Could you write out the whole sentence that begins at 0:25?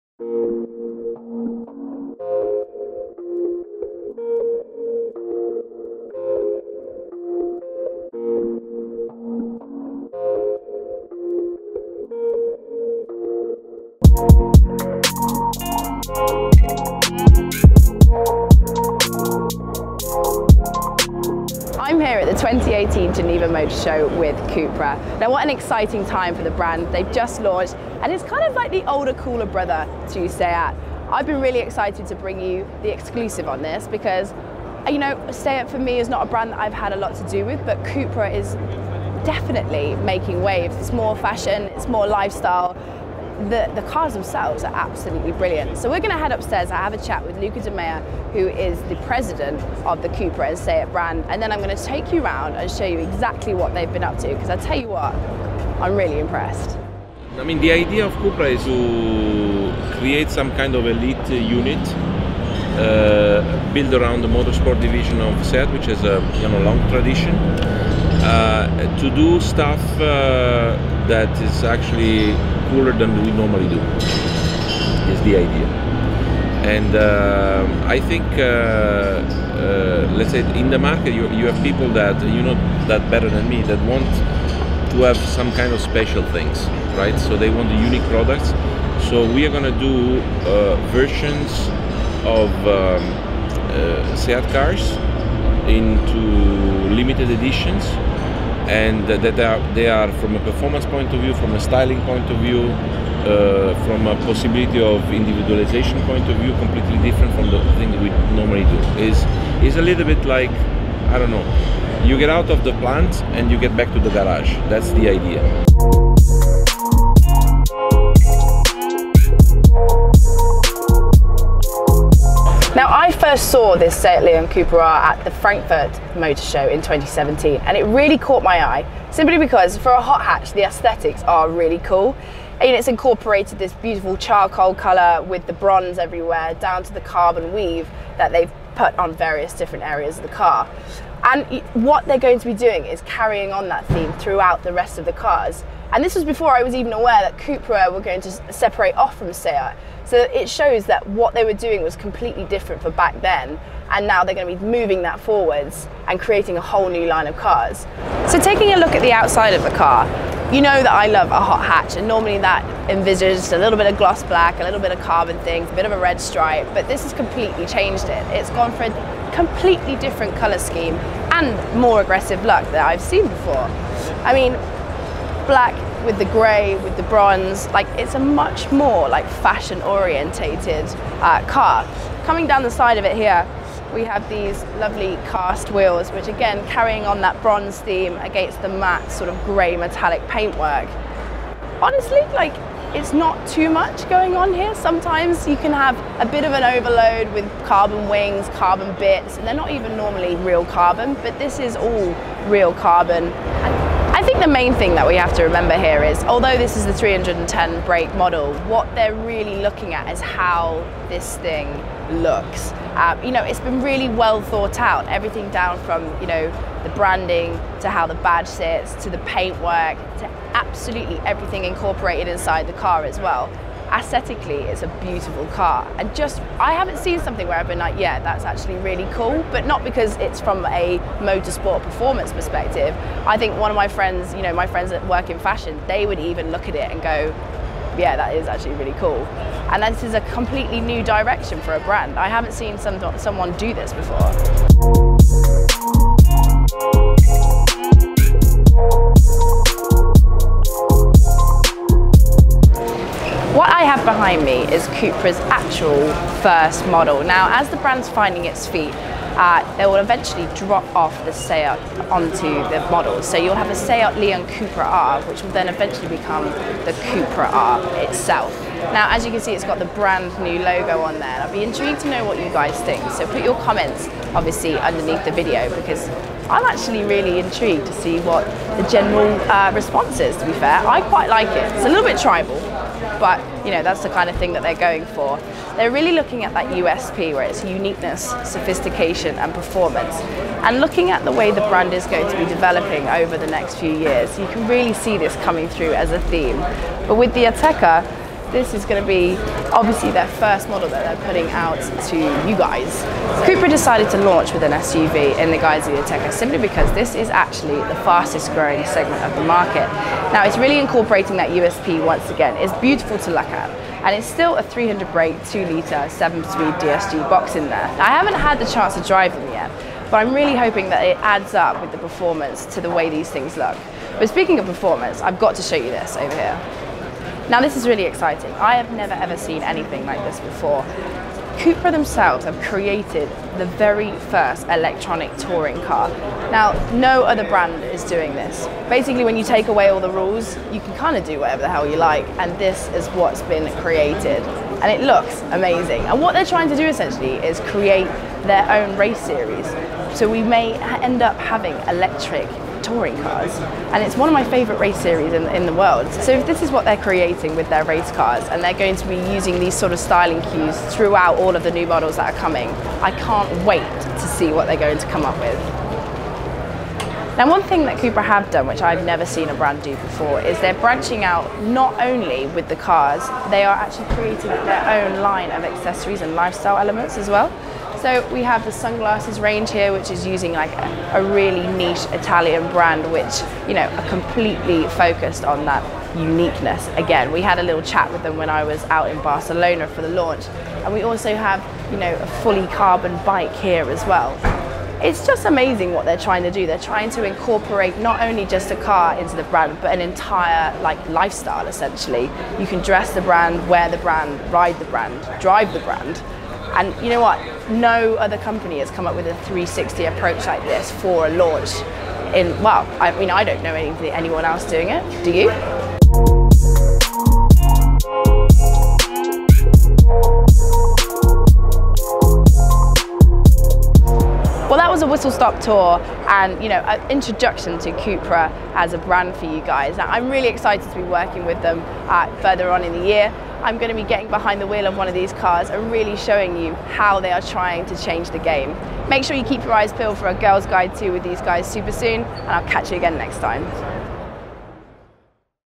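Now what an exciting time for the brand.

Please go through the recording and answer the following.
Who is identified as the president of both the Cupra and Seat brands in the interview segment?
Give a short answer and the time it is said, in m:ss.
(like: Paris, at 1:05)
Luca De Meo, at 0:47.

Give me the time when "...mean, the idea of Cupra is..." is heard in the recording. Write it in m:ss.
0:57.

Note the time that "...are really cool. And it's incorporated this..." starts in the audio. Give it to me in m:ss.
2:11.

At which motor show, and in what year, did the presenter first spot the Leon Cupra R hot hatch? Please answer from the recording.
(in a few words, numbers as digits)
Frankfurt 2017.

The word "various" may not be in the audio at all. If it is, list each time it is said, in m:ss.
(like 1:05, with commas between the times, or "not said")
2:19.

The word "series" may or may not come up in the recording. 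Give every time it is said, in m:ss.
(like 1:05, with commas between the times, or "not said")
5:49, 5:54.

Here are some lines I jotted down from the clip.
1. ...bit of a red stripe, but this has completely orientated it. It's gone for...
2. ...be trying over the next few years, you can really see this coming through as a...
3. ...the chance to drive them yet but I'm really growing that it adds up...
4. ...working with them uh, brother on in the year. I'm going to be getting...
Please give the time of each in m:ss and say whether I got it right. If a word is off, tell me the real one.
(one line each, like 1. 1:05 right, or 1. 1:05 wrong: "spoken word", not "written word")
1. 2:45 wrong: "changed", not "orientated"
2. 4:52 wrong: "developing", not "trying"
3. 5:18 wrong: "hoping", not "growing"
4. 7:11 wrong: "further", not "brother".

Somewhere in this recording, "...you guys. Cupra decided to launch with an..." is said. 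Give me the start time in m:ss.
5:02.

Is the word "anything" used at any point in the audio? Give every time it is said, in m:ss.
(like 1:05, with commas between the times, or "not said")
5:29.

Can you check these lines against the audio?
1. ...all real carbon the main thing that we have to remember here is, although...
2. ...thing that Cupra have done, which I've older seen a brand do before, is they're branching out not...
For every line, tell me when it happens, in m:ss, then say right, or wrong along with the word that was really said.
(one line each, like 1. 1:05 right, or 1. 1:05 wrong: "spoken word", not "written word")
1. 3:21 right
2. 6:07 wrong: "never", not "older".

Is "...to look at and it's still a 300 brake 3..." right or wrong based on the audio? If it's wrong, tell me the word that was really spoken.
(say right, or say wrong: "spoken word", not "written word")
wrong: "2", not "3".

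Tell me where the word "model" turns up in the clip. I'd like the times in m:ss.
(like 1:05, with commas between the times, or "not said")
3:28, 4:16, 4:22, 5:00, 6:01.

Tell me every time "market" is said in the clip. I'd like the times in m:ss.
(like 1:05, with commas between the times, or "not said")
1:20, 5:09.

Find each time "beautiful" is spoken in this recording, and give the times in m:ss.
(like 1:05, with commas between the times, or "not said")
2:13, 3:45, 5:12.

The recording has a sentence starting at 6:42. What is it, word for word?
You can dress the brand, wear the brand, ride the brand, drive the brand, and you know what?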